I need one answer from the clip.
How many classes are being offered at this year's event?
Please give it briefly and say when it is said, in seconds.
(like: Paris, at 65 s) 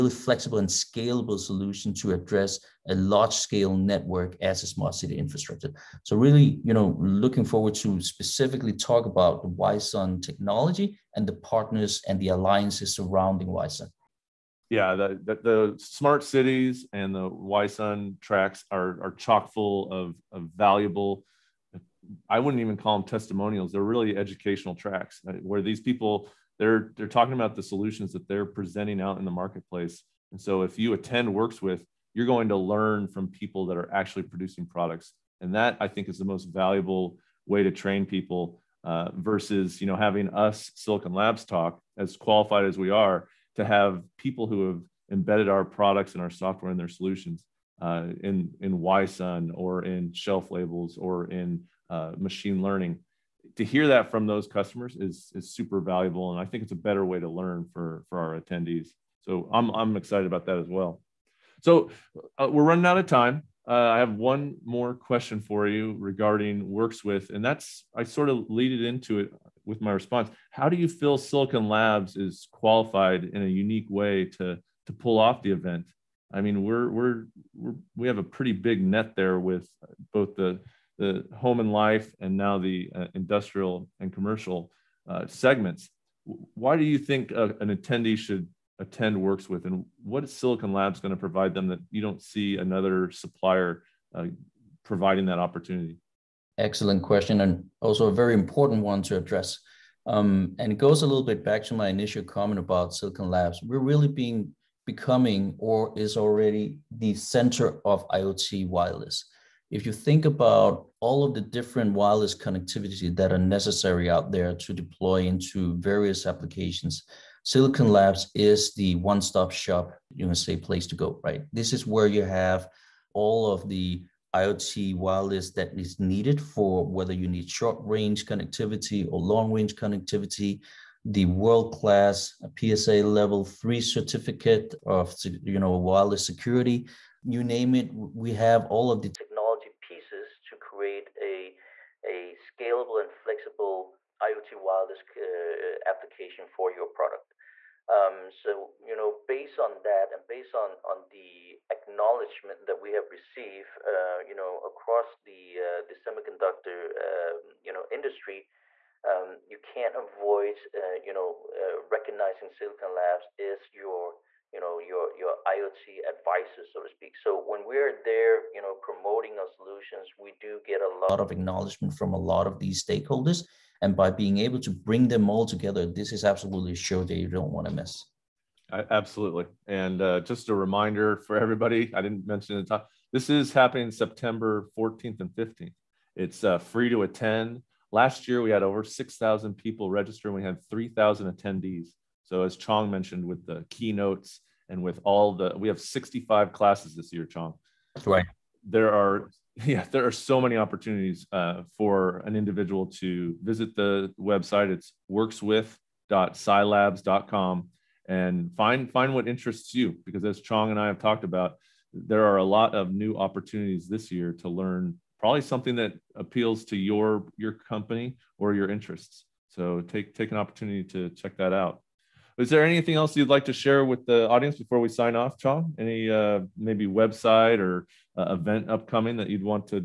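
65, at 195 s.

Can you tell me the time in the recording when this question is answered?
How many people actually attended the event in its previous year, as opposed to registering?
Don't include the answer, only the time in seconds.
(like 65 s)
190 s.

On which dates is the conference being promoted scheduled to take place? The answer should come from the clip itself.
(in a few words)
September 14 and 15.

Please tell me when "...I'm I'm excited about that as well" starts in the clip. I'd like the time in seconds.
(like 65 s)
59 s.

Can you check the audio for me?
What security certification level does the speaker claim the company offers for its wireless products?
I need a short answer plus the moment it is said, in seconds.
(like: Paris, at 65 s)
PSA level 3, at 132 s.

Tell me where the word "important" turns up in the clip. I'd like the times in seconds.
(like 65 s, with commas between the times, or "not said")
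98 s.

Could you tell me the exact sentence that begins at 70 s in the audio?
How do you feel Silicon Labs is qualified in a unique way to to pull off the event?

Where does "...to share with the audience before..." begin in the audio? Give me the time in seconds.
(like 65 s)
223 s.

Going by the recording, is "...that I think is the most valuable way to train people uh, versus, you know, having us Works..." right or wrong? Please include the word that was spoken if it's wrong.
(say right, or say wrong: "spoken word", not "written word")
wrong: "Silicon", not "Works".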